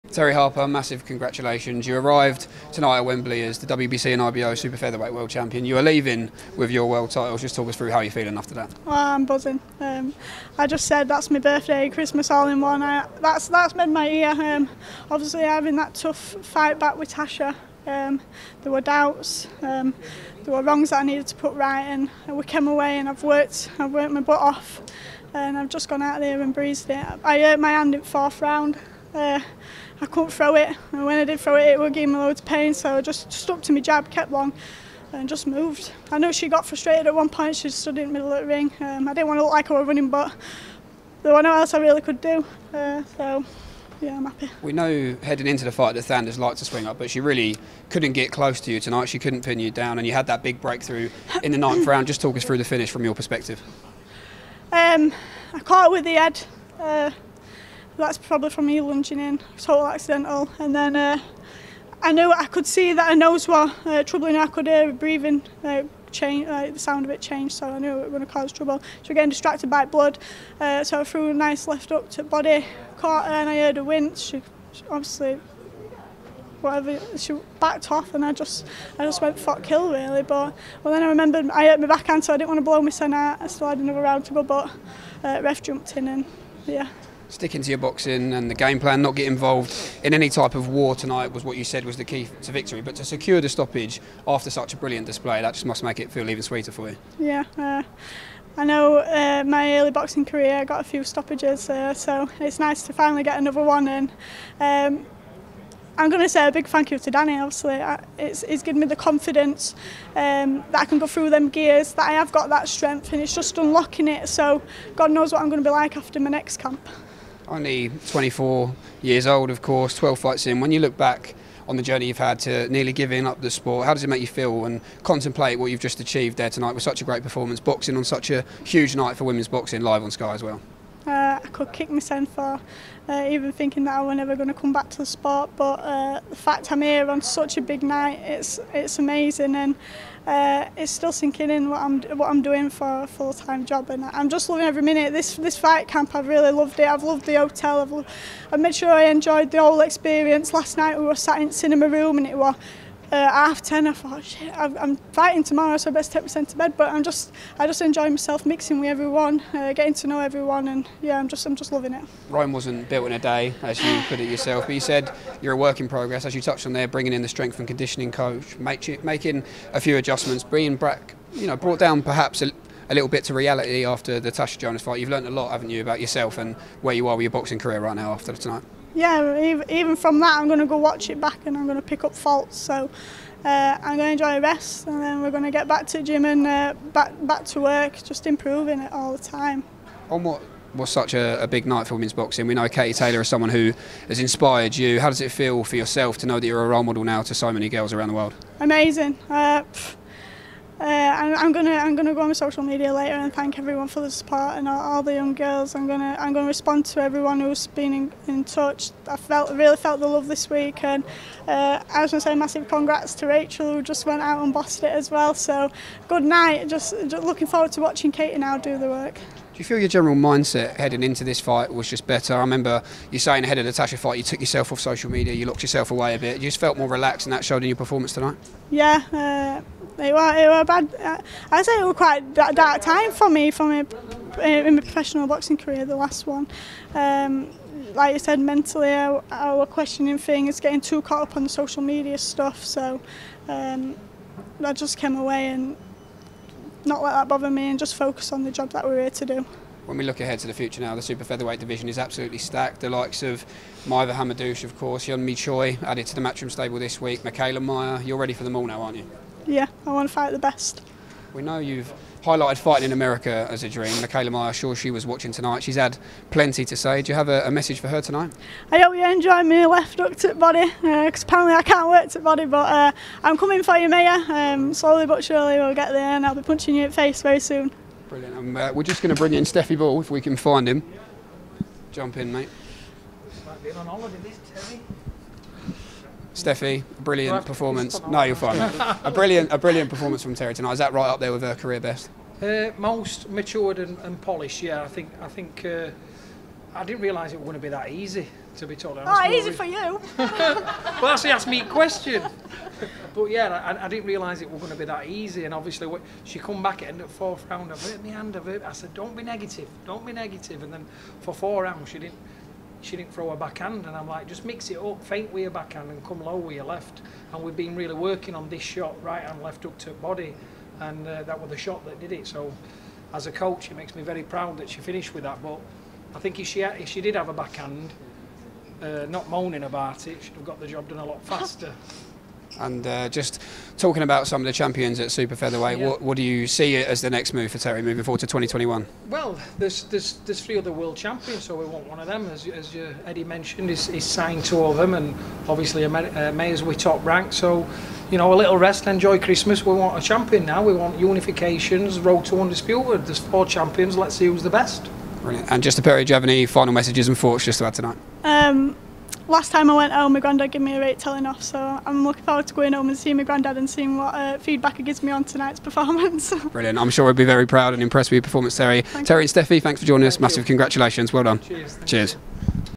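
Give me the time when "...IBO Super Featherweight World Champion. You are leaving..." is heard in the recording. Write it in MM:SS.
00:04.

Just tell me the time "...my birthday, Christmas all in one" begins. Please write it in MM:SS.
00:11.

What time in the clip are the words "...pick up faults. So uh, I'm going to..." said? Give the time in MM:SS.
03:01.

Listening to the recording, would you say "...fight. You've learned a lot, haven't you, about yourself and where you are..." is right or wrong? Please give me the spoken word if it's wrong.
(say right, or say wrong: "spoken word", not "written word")
right.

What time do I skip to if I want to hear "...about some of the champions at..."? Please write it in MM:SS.
05:34.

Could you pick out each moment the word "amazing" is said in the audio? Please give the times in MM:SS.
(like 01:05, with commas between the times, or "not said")
02:18, 03:18.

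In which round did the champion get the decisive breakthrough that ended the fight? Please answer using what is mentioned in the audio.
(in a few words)
ninth.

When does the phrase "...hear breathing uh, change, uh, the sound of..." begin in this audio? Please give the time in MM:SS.
01:04.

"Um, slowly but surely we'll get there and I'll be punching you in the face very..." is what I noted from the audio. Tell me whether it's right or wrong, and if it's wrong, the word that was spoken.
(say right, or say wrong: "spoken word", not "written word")
right.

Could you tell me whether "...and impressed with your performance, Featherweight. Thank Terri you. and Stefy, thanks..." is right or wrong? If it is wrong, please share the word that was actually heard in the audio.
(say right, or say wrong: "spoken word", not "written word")
wrong: "Terri", not "Featherweight".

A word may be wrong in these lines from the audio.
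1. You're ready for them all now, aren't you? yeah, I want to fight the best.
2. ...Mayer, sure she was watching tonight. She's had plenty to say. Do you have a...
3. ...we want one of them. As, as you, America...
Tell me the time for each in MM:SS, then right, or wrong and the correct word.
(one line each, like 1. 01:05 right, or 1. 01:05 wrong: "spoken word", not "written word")
1. 04:18 right
2. 04:24 right
3. 05:41 wrong: "Eddie", not "America".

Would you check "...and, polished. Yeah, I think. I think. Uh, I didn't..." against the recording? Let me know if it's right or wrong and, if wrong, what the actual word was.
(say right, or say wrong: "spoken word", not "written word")
right.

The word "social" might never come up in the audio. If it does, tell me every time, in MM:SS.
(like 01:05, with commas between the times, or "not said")
03:22, 03:44, 04:01.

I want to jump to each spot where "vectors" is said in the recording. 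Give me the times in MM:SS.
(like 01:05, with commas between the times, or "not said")
not said.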